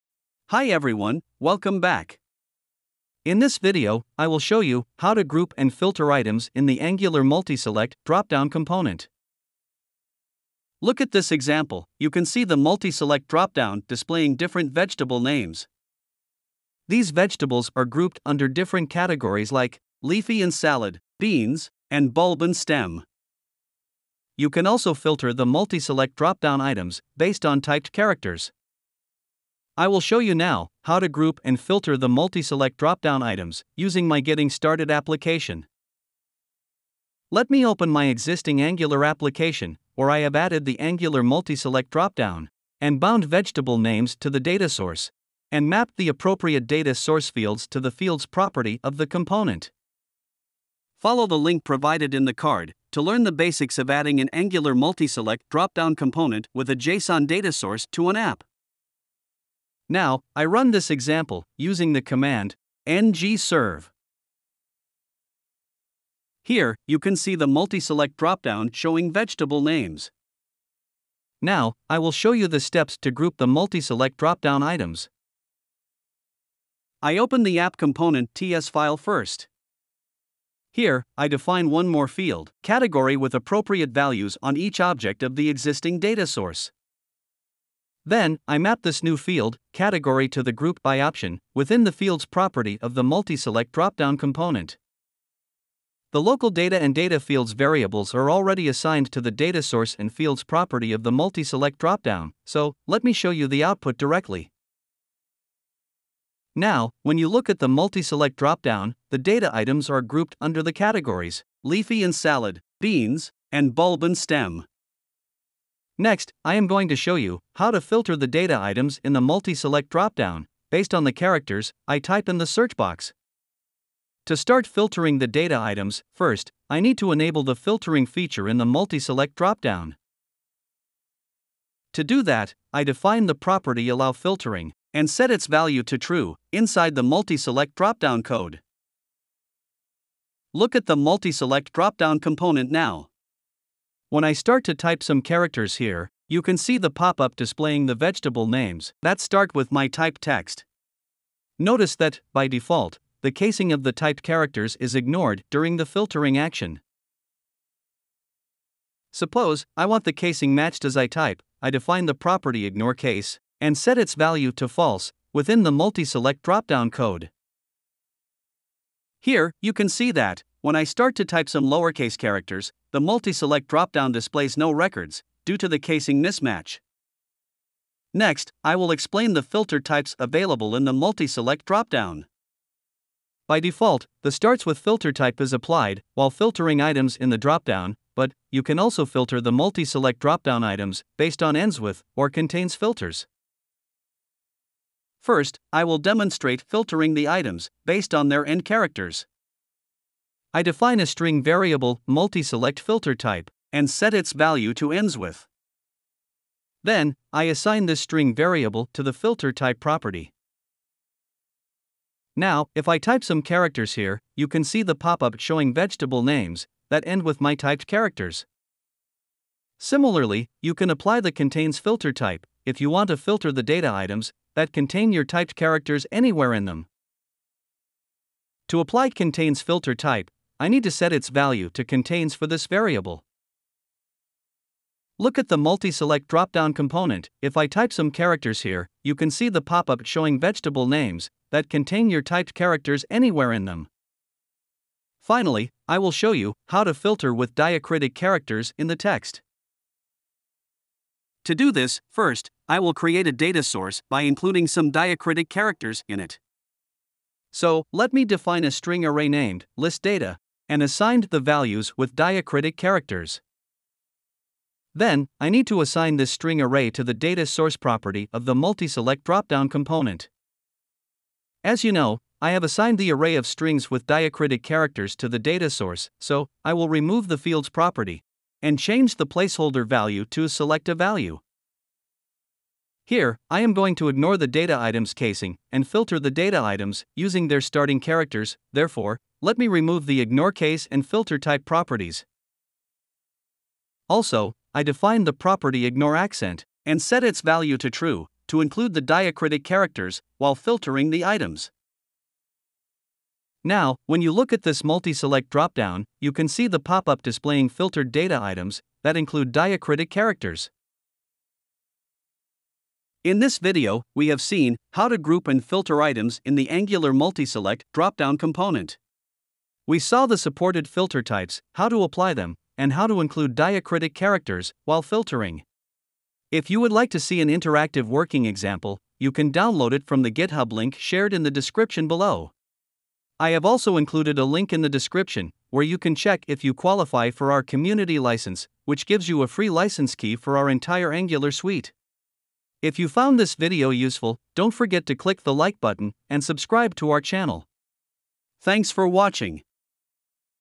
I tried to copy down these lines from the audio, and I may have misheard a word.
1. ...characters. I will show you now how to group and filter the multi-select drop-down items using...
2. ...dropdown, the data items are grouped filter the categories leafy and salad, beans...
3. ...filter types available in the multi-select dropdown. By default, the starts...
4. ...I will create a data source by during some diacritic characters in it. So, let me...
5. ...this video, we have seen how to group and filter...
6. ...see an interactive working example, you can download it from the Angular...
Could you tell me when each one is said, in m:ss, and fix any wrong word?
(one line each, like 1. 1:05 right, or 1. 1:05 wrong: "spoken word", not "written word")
1. 0:27 right
2. 1:48 wrong: "under", not "filter"
3. 2:59 right
4. 4:12 wrong: "including", not "during"
5. 5:13 right
6. 5:27 wrong: "GitHub", not "Angular".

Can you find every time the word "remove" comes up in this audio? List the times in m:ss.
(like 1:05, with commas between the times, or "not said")
4:36, 4:49.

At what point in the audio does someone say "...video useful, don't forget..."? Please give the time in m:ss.
5:43.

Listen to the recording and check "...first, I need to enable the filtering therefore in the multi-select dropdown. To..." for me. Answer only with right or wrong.
wrong.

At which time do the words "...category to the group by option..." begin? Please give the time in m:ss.
1:29.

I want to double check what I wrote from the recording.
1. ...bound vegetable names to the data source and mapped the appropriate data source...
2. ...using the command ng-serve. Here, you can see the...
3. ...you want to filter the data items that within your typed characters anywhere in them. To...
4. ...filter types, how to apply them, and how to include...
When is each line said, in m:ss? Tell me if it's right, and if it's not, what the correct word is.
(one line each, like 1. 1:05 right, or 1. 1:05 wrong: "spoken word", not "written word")
1. 0:42 right
2. 1:01 right
3. 3:42 wrong: "contain", not "within"
4. 5:20 right.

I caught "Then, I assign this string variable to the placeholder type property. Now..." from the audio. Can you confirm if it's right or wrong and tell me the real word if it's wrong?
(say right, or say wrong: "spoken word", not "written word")
wrong: "filter", not "placeholder".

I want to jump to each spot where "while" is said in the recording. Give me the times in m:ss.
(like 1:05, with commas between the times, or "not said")
3:06, 5:00, 5:24.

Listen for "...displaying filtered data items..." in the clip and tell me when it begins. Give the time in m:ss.
5:07.